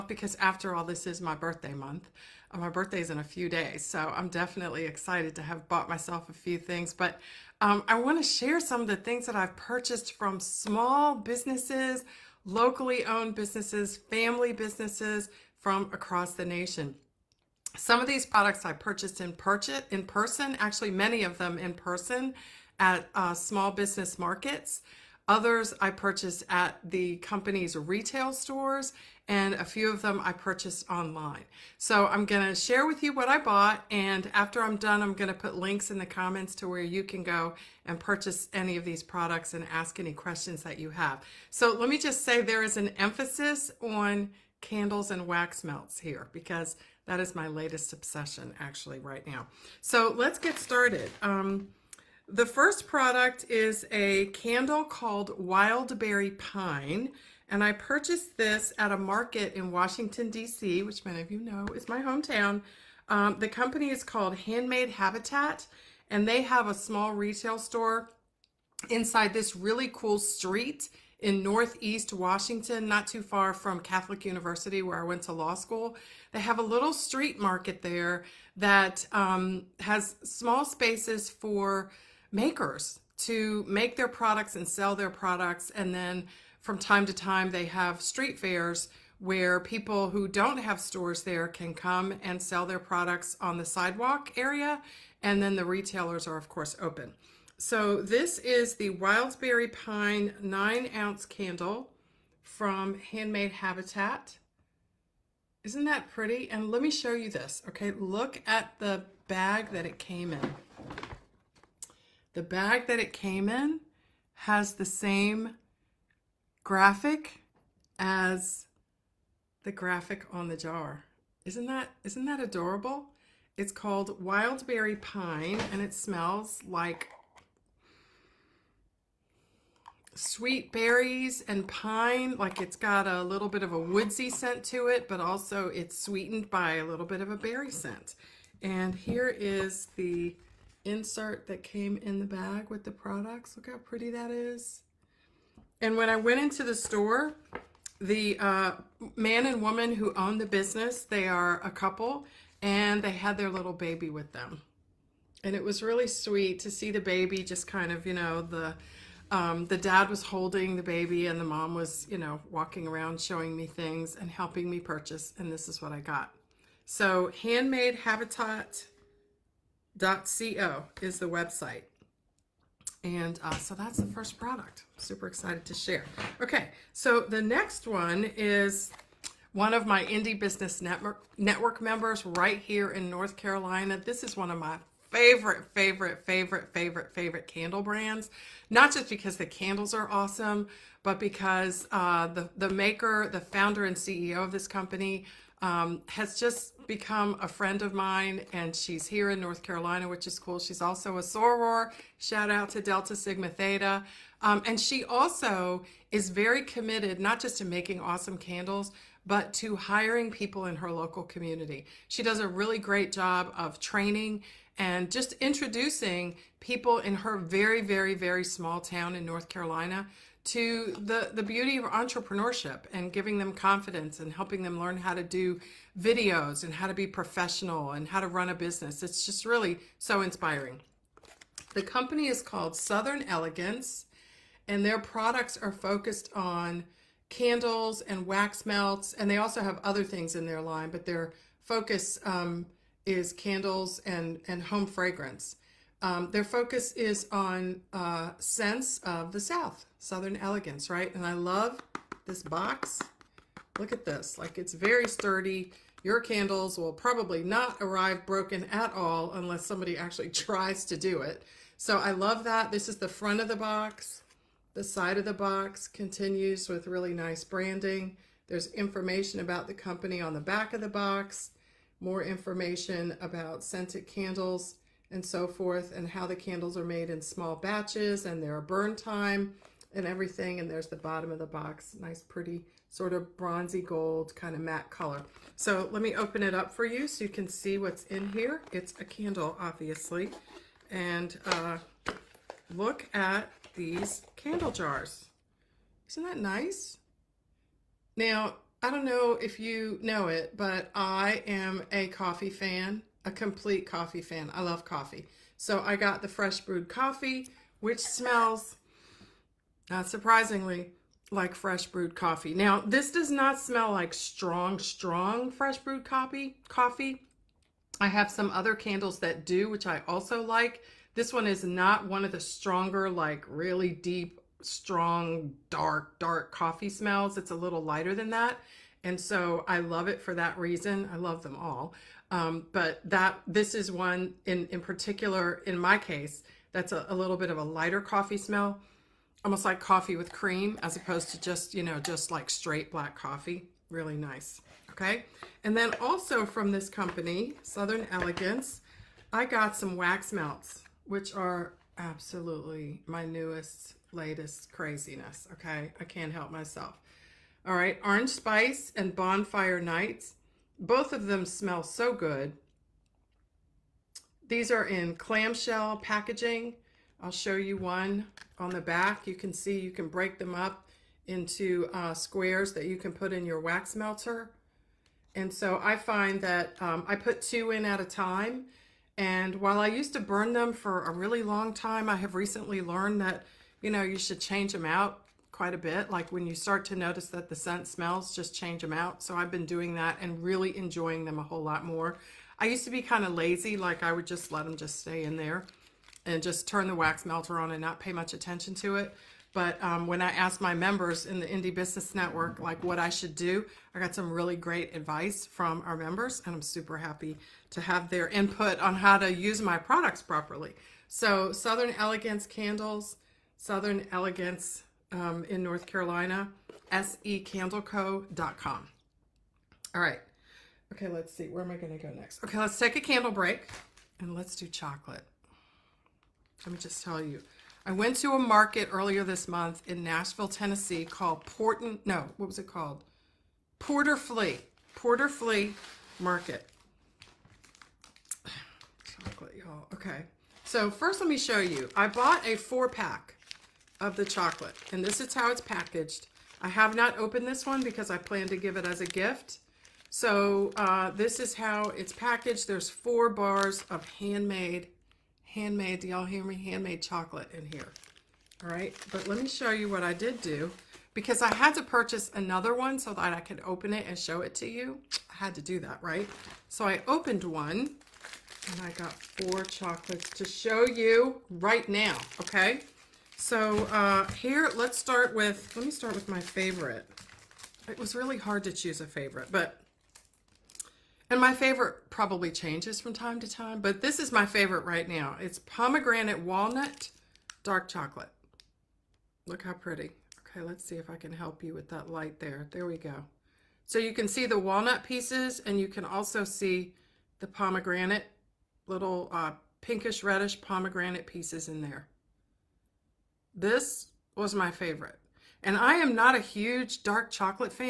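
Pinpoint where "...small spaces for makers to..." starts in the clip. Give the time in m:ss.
1:20.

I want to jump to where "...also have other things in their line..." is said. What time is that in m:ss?
3:59.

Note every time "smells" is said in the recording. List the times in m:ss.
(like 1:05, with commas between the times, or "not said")
2:05, 5:08, 5:13, 5:26, 5:38, 6:01, 6:27.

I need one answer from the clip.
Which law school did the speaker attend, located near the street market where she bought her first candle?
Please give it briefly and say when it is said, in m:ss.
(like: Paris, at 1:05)
Catholic University, at 1:13.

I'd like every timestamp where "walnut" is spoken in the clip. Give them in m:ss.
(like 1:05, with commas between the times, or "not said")
8:06, 8:14.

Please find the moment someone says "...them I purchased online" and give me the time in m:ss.
0:30.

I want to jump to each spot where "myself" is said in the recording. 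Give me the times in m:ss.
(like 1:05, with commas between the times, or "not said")
0:05, 5:56.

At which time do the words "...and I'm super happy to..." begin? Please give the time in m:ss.
6:46.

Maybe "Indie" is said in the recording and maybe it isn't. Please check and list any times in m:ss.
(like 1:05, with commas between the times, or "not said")
3:00, 6:41.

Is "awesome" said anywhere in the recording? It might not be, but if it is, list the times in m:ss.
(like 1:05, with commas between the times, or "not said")
3:10, 3:28.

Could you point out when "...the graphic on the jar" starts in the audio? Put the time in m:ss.
1:59.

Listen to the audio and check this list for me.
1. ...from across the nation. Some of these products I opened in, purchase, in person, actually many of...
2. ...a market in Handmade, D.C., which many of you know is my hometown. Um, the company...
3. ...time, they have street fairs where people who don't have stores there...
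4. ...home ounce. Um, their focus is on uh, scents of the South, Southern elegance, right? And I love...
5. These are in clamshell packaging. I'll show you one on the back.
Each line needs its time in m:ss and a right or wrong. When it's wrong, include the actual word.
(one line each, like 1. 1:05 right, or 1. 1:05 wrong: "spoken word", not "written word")
1. 0:15 wrong: "purchased", not "opened"
2. 0:58 wrong: "Washington", not "Handmade"
3. 1:27 right
4. 4:04 wrong: "fragrance", not "ounce"
5. 6:04 right.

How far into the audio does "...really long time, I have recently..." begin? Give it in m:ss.
6:21.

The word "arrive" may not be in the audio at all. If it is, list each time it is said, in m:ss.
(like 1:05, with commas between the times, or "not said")
4:17.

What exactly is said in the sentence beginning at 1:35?
And then the retailers are, of course, open.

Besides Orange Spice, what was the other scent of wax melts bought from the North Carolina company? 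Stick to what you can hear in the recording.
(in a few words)
Bonfire Nights.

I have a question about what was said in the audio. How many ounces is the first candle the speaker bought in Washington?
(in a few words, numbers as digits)
9.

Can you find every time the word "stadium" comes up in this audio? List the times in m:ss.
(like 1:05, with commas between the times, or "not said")
not said.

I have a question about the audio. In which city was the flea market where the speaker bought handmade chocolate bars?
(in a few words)
Nashville.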